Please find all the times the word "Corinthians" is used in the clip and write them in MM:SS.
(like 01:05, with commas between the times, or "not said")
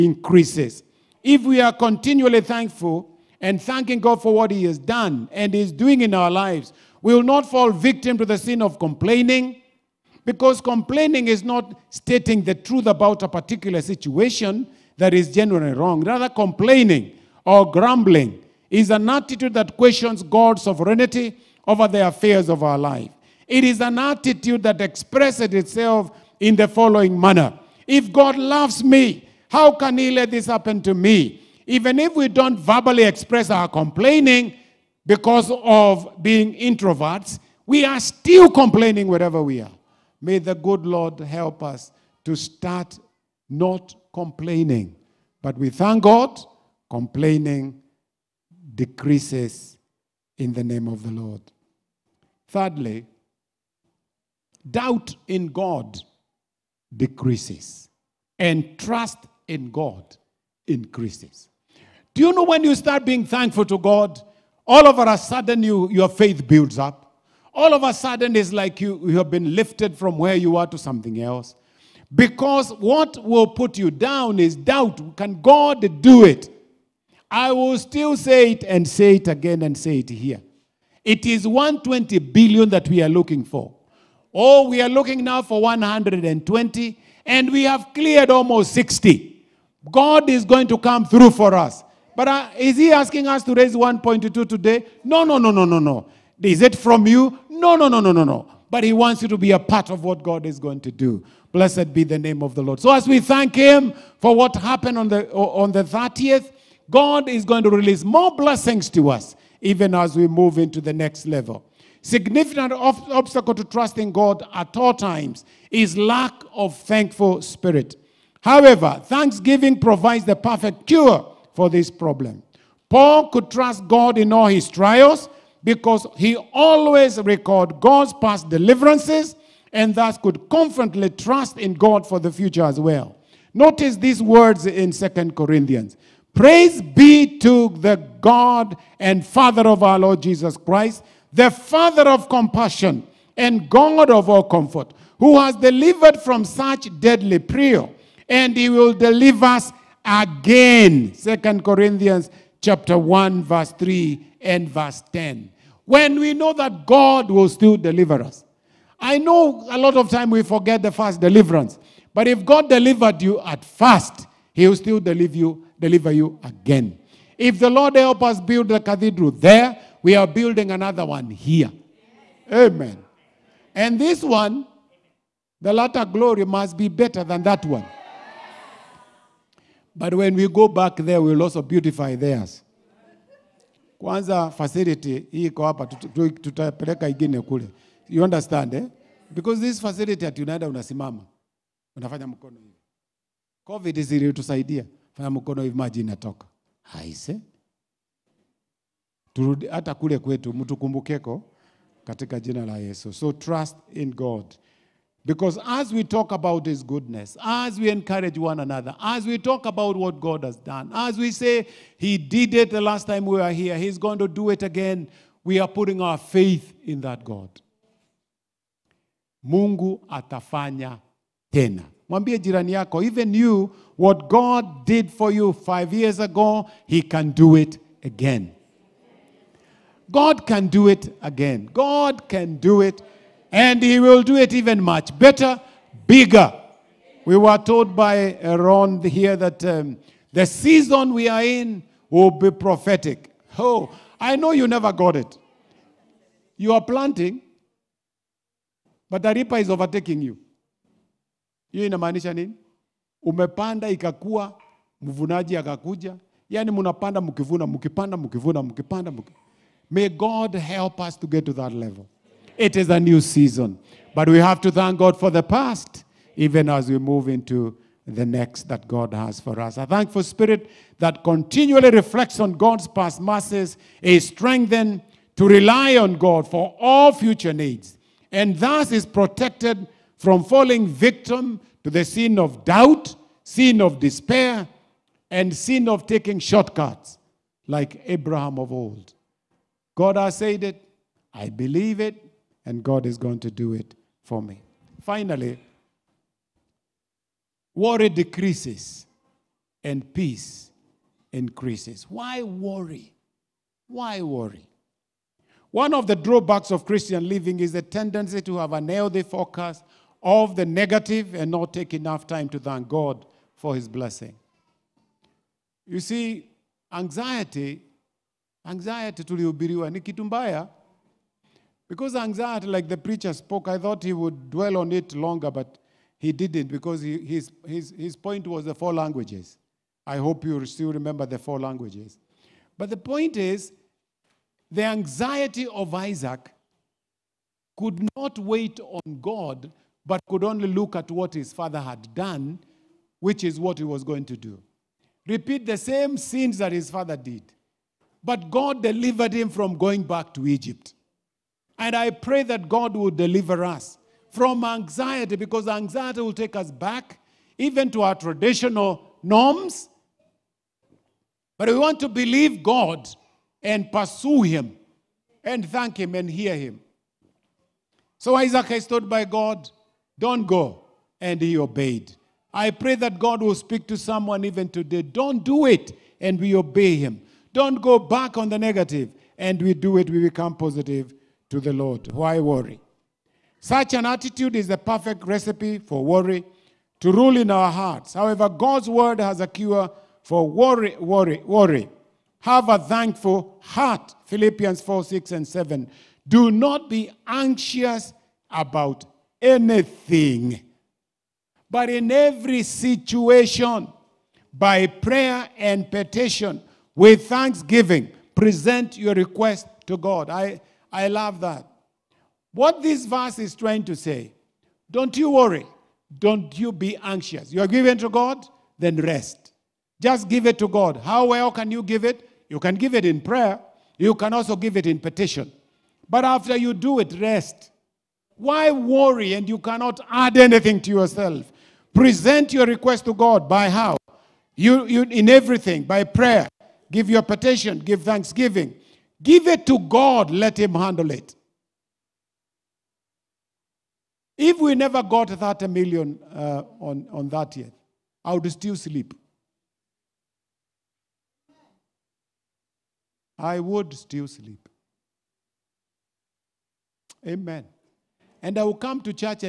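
02:15, 02:31.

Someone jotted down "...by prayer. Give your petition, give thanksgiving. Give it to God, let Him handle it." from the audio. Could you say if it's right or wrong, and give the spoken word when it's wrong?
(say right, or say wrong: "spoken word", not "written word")
right.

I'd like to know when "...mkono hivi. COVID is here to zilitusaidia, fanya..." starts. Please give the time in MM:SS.
03:12.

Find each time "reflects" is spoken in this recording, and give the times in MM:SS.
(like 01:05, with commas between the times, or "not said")
04:31.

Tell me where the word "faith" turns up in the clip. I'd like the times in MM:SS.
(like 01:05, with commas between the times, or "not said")
01:06, 03:36.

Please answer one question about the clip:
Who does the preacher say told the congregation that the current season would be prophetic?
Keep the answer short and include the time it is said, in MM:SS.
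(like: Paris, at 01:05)
Ron, at 03:58.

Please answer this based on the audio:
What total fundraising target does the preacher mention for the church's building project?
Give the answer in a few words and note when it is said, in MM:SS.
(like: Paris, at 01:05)
120 billion, at 01:21.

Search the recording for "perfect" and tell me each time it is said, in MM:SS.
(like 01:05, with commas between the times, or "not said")
02:00, 06:24.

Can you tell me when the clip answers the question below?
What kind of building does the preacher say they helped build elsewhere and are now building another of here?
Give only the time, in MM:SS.
02:48.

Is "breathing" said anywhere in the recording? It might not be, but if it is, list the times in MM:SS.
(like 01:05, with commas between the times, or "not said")
not said.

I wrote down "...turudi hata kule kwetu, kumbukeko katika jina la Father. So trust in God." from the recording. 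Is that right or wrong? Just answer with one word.
wrong.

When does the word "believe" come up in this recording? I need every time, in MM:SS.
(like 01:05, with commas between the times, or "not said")
04:51, 06:02.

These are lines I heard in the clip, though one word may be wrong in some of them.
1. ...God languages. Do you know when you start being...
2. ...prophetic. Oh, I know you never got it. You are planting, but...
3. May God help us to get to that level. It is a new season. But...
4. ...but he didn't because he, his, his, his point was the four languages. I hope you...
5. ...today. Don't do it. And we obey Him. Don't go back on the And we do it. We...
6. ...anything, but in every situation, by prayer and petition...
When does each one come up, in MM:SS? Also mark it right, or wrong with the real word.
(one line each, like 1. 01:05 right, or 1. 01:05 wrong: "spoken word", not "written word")
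1. 00:59 wrong: "increases", not "languages"
2. 04:02 right
3. 04:19 right
4. 05:25 right
5. 06:14 right
6. 06:39 right.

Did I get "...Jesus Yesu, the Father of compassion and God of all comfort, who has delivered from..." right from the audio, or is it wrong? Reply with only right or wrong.
wrong.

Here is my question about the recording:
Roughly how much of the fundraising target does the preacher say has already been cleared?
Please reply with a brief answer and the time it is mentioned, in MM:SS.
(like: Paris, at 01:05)
almost 60, at 01:28.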